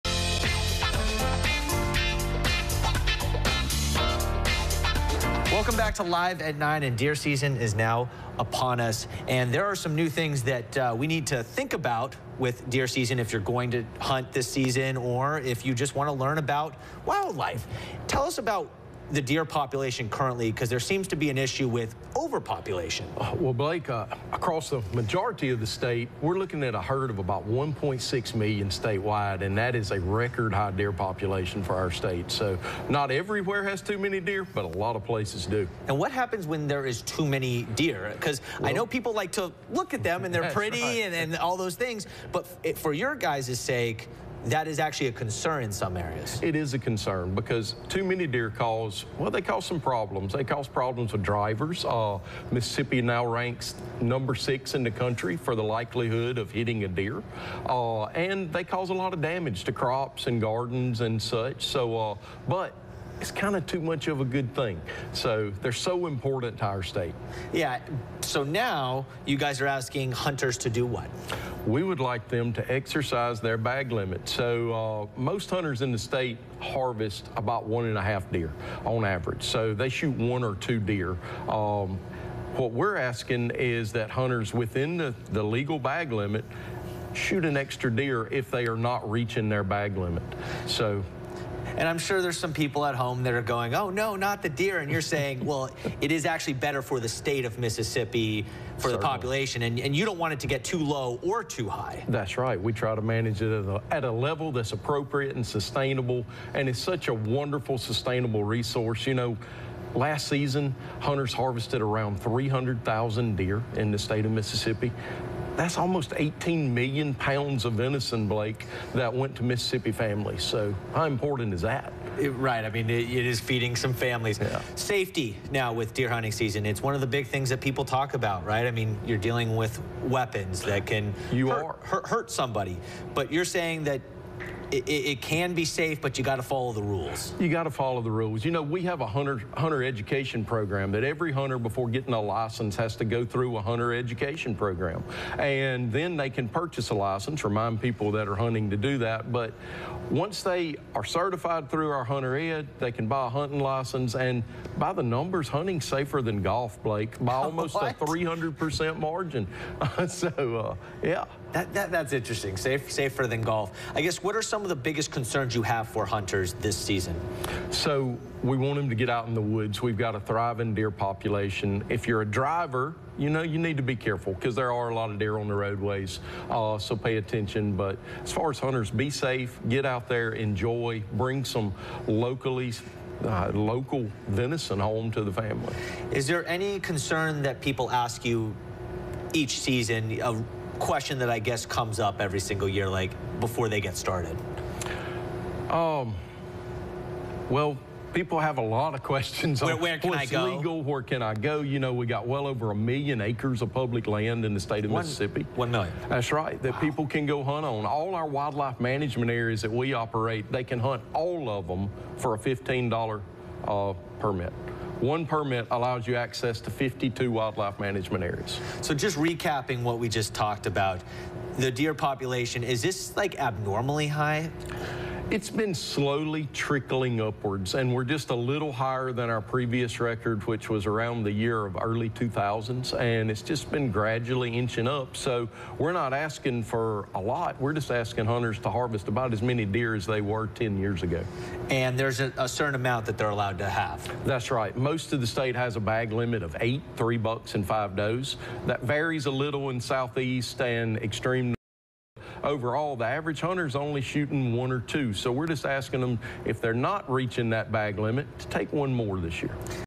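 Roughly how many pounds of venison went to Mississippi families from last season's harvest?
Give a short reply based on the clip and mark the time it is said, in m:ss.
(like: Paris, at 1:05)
18 million pounds, at 1:56.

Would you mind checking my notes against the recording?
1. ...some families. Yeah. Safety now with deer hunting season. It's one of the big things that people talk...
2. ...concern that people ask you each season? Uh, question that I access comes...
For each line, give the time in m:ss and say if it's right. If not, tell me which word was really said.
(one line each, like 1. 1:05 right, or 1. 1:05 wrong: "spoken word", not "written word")
1. 2:03 right
2. 3:06 wrong: "guess", not "access".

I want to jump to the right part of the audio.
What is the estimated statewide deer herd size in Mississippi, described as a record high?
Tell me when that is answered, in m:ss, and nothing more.
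0:27.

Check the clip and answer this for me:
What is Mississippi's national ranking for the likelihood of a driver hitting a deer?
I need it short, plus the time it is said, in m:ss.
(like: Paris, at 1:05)
6, at 0:54.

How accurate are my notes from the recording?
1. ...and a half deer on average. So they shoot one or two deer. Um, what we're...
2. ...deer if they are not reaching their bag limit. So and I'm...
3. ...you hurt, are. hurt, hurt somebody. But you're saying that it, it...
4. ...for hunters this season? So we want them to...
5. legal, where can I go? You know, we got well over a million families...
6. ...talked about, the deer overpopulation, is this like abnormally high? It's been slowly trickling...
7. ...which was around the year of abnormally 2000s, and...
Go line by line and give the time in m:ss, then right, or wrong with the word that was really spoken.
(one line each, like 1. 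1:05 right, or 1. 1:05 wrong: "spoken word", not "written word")
1. 1:17 right
2. 1:27 right
3. 2:11 right
4. 2:45 right
5. 3:20 wrong: "acres", not "families"
6. 3:40 wrong: "population", not "overpopulation"
7. 3:50 wrong: "early", not "abnormally".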